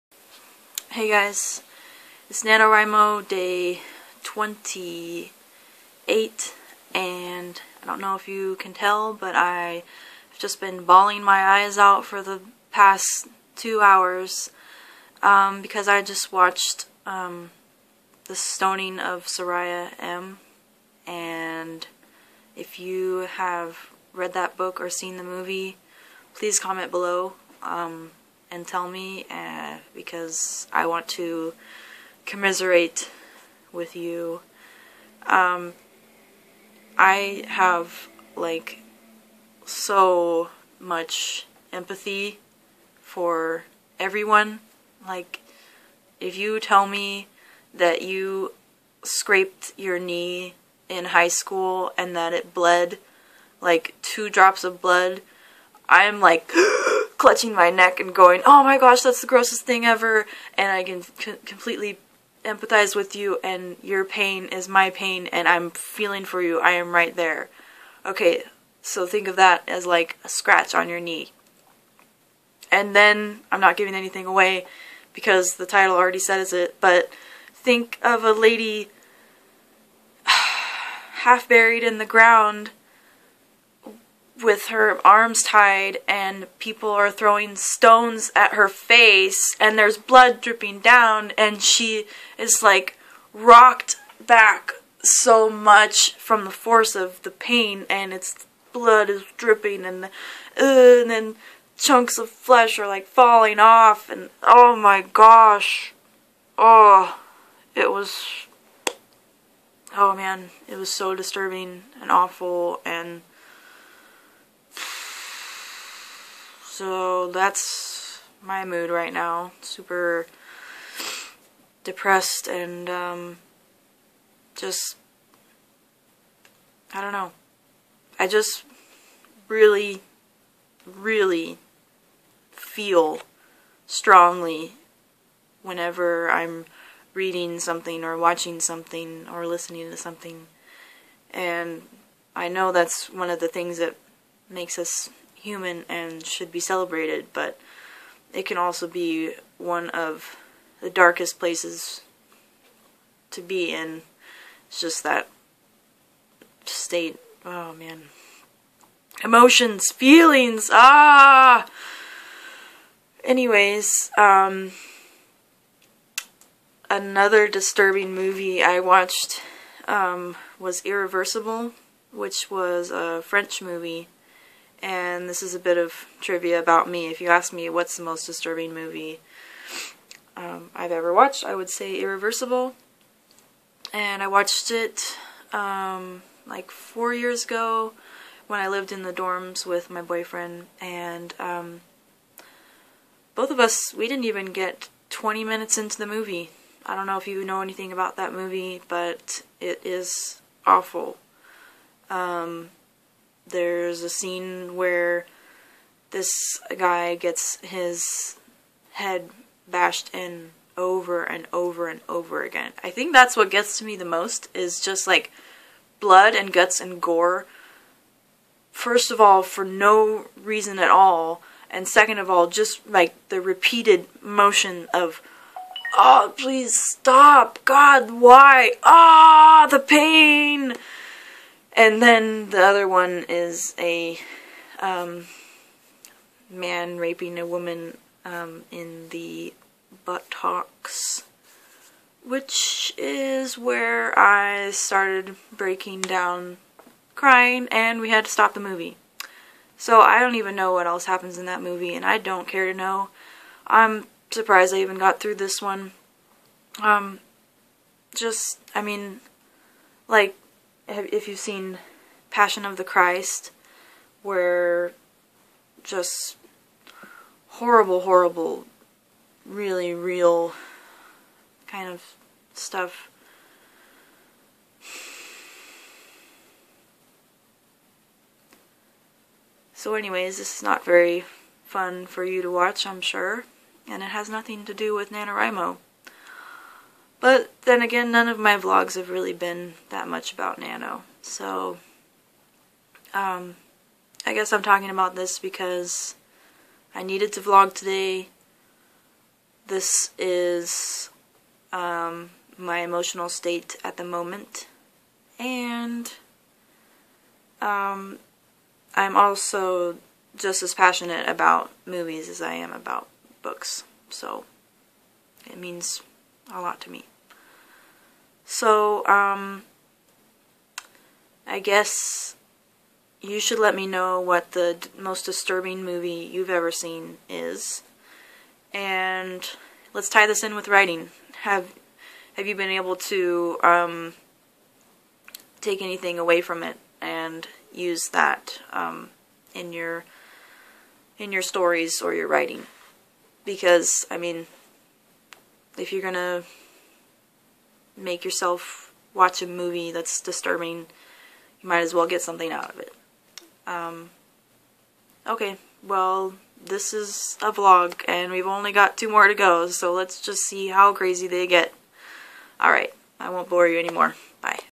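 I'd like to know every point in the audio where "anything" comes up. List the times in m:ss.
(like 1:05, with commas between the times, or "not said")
1:13, 3:17, 5:35.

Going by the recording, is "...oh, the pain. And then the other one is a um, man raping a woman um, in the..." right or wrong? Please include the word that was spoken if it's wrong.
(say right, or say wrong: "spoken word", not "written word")
right.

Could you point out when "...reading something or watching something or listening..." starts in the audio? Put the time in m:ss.
2:17.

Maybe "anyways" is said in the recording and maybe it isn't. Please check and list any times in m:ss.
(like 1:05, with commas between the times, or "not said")
2:43, 4:39.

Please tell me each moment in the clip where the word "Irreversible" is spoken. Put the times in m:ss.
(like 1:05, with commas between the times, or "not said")
2:50, 3:01.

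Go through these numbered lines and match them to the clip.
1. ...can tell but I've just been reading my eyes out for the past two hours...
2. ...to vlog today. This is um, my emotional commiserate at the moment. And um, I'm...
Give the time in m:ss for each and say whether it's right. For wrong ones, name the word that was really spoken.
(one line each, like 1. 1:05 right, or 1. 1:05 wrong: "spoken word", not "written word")
1. 0:08 wrong: "bawling", not "reading"
2. 4:57 wrong: "state", not "commiserate".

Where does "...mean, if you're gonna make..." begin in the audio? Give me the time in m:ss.
5:44.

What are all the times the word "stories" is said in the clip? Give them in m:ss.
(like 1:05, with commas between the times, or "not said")
5:41.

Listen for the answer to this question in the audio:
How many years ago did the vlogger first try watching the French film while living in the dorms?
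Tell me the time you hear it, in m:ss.
3:06.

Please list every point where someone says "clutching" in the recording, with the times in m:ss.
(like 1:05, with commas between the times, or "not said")
0:57.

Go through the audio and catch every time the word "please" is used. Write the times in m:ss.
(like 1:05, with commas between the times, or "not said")
0:26, 3:46.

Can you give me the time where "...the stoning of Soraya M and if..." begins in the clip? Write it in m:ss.
0:18.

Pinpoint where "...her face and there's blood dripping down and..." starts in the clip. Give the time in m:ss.
1:28.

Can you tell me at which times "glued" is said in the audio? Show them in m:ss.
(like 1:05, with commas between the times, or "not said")
not said.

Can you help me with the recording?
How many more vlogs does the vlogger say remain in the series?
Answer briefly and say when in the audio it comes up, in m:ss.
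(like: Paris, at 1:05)
2, at 5:58.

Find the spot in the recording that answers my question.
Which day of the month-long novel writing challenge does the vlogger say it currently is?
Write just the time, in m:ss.
0:03.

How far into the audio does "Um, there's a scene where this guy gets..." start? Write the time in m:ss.
3:22.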